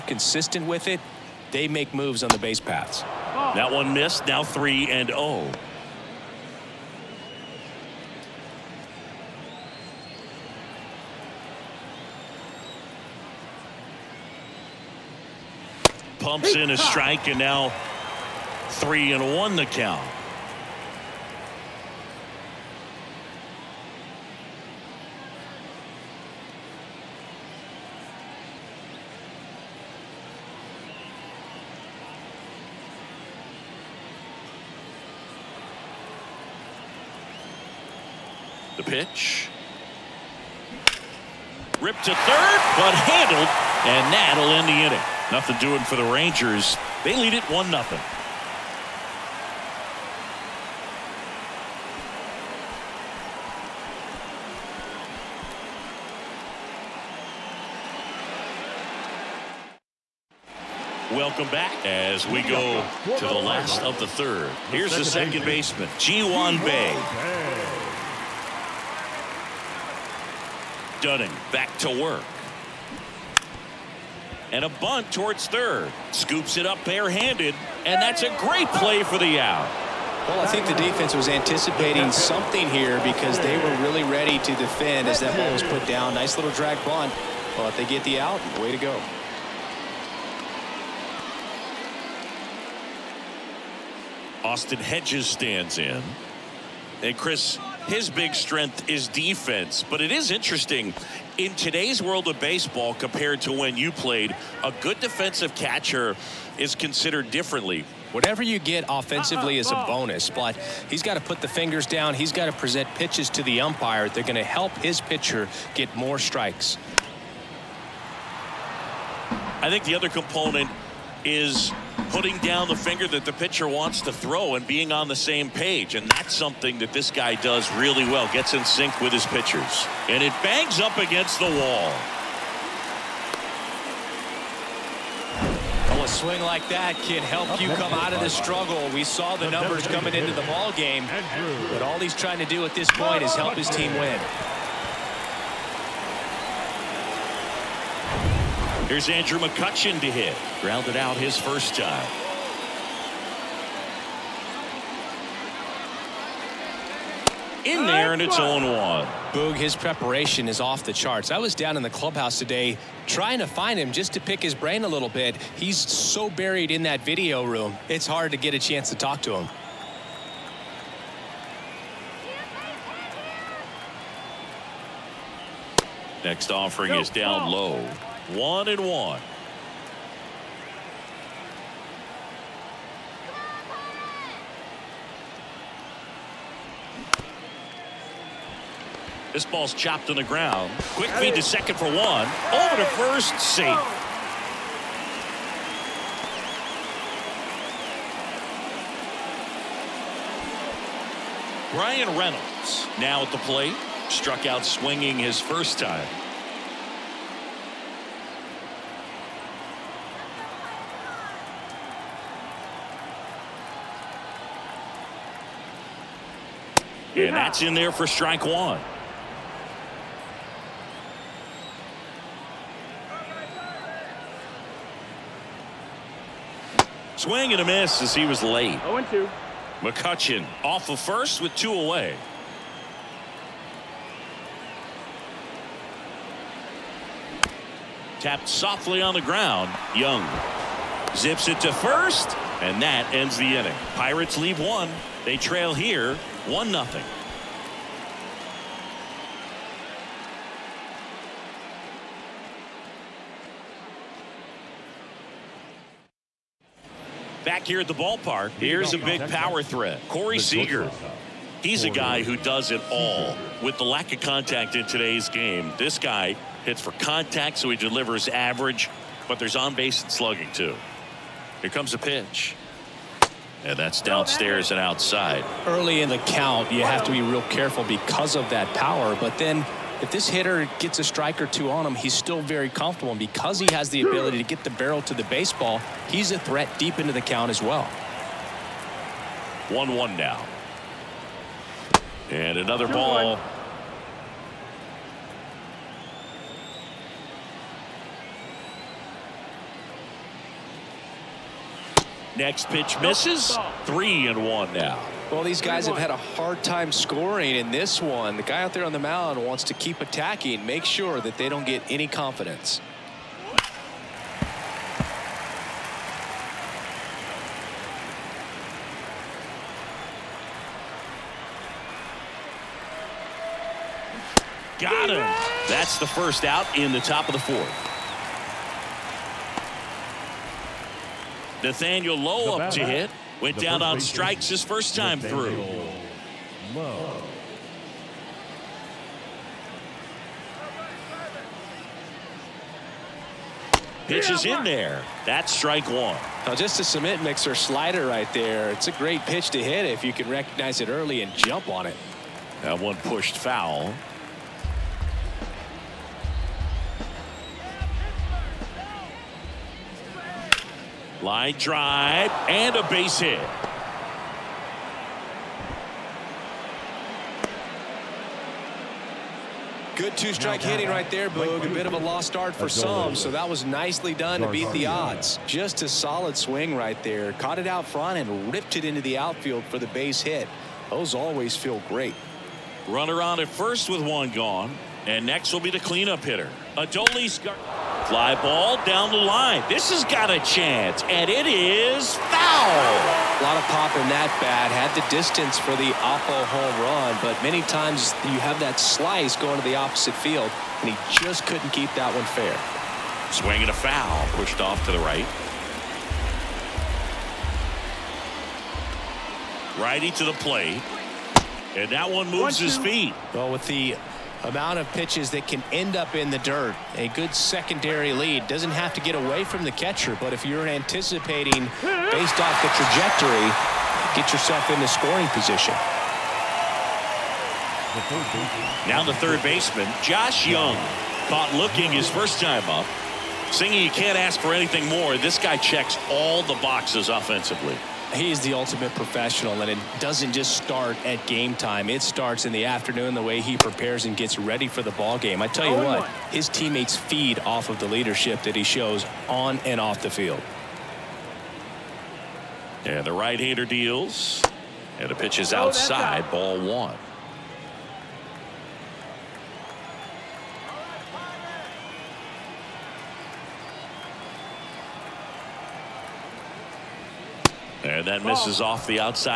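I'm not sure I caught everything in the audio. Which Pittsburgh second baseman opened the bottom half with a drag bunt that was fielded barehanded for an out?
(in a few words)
Ji Hwan Bae.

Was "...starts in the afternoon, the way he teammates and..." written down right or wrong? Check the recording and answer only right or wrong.
wrong.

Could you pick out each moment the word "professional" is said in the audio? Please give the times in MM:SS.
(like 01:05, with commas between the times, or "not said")
07:18.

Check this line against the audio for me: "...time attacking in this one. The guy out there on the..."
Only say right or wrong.
wrong.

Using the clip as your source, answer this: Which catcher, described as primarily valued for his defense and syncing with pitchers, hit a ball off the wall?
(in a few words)
Austin Hedges.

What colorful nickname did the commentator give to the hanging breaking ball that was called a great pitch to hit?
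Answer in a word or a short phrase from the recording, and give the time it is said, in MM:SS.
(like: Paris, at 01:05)
cement mixer slider, at 05:46.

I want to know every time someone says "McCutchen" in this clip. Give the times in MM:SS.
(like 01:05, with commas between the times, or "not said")
02:29, 03:49.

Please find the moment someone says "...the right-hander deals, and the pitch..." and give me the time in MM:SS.
07:33.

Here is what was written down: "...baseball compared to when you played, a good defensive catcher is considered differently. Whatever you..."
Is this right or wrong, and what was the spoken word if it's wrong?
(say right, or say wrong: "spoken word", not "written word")
right.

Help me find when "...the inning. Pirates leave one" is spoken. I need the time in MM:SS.
04:03.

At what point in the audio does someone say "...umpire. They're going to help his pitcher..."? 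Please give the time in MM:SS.
01:53.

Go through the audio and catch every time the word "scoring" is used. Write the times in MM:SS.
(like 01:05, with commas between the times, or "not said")
05:06, 07:04.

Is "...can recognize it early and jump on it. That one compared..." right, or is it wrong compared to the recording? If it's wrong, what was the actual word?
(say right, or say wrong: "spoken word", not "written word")
wrong: "pushed", not "compared".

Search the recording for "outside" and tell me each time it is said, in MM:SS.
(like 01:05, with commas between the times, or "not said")
04:34, 07:35.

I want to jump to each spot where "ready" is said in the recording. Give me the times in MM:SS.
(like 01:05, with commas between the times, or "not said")
01:24, 07:24.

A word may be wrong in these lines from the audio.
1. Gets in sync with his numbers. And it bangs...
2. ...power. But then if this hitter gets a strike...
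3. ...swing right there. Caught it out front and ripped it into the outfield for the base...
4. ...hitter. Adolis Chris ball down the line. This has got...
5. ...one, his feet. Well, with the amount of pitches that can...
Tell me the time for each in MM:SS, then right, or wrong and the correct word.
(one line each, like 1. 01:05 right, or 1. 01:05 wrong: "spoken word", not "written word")
1. 02:08 wrong: "pitchers", not "numbers"
2. 04:38 right
3. 06:16 right
4. 06:26 wrong: "Fly", not "Chris"
5. 06:52 right.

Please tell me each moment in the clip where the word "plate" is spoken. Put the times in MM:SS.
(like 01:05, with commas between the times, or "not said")
03:23, 06:50.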